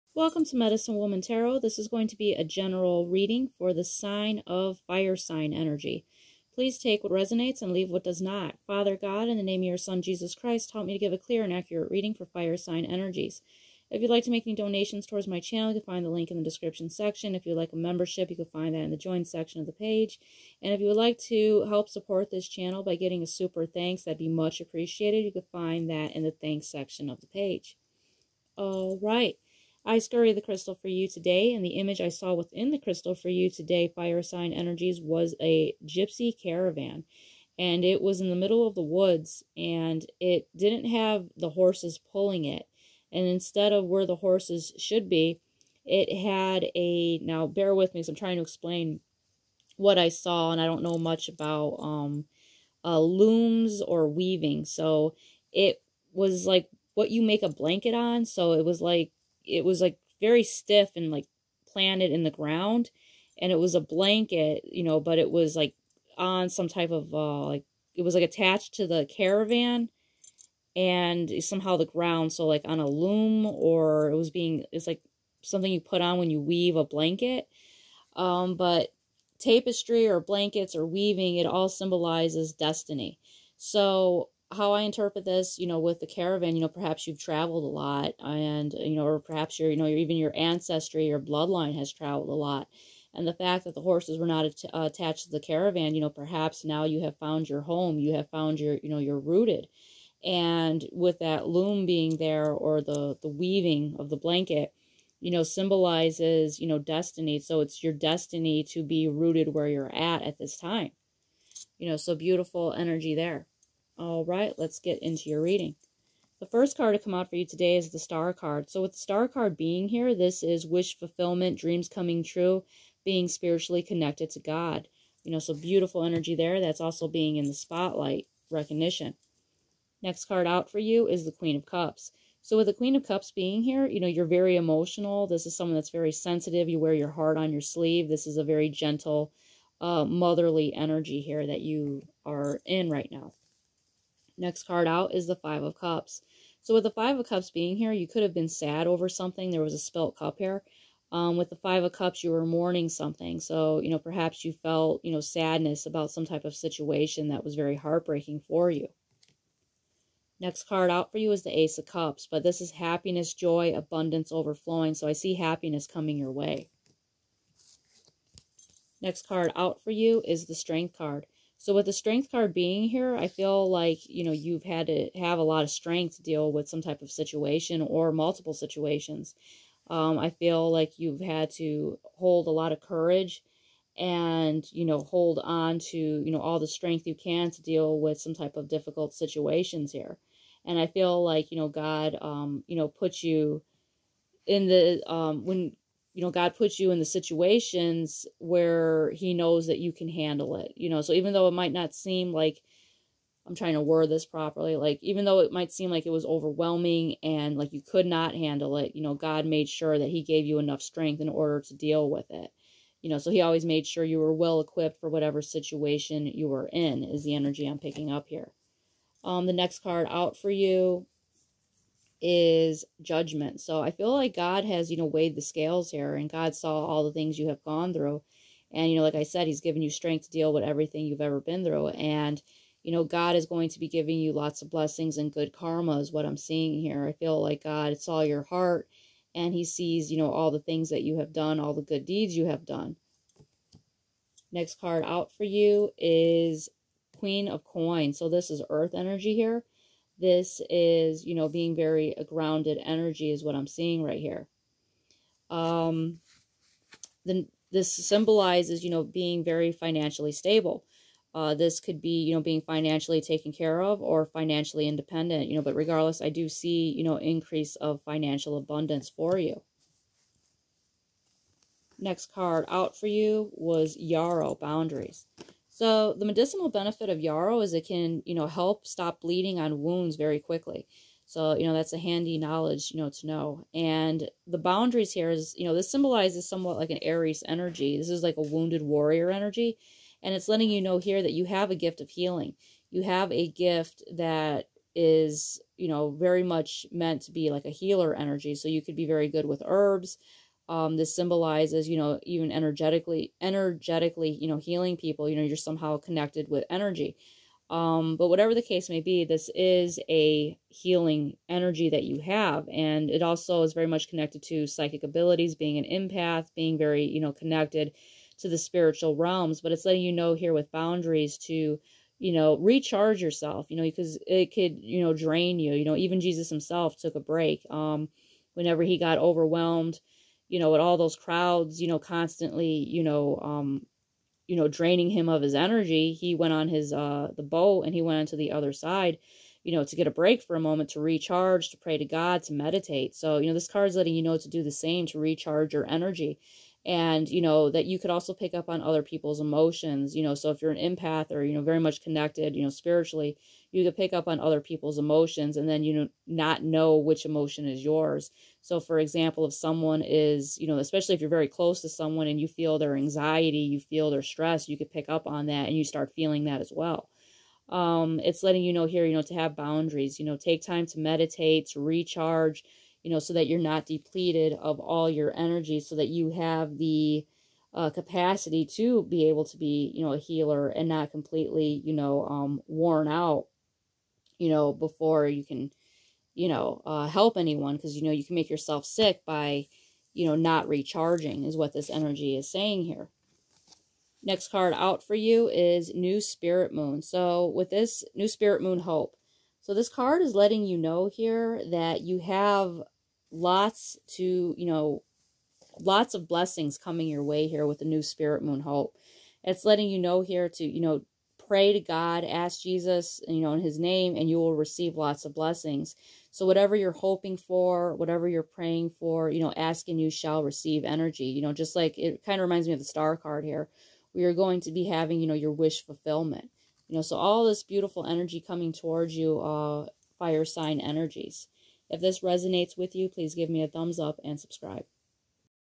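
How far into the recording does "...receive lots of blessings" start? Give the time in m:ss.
6:54.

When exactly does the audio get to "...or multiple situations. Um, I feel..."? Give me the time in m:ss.
2:57.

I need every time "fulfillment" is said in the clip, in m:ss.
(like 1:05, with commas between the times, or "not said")
2:00, 7:05.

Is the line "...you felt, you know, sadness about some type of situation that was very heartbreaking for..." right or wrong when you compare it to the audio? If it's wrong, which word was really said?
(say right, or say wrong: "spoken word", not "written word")
right.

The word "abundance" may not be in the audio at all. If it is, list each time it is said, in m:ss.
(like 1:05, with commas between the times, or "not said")
2:43, 4:28.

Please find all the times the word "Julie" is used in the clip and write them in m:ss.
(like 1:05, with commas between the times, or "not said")
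not said.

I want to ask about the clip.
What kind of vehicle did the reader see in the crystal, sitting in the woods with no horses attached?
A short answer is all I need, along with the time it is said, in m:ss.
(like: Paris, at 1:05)
Gypsy caravan, at 0:35.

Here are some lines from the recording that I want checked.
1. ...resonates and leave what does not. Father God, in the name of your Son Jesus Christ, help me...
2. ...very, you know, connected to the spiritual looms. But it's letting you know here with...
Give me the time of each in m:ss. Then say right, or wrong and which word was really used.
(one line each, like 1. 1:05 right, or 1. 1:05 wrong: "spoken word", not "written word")
1. 0:07 right
2. 5:16 wrong: "realms", not "looms".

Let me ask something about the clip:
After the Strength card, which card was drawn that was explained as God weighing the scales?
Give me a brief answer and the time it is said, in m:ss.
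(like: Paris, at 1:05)
Judgment, at 3:43.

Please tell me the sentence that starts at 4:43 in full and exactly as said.
And the boundaries here is, you know, this symbolizes somewhat like an Aries energy.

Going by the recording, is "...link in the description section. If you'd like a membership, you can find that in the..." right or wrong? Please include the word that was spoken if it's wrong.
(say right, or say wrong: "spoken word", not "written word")
right.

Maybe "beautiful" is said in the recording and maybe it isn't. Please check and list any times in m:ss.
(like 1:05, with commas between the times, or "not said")
1:52, 2:05, 7:07.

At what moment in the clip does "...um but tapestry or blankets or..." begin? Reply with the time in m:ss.
1:18.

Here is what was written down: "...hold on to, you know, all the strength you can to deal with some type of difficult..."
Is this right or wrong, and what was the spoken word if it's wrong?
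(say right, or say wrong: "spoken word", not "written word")
right.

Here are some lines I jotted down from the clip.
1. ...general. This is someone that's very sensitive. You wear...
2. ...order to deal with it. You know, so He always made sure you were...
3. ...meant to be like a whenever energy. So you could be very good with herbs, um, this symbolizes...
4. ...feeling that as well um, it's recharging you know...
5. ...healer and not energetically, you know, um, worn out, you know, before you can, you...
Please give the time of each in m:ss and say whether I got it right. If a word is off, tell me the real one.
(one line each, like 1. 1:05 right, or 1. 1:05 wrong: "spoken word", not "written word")
1. 2:14 wrong: "emotional", not "general"
2. 3:31 right
3. 4:56 wrong: "healer", not "whenever"
4. 6:06 wrong: "letting", not "recharging"
5. 6:20 wrong: "completely", not "energetically".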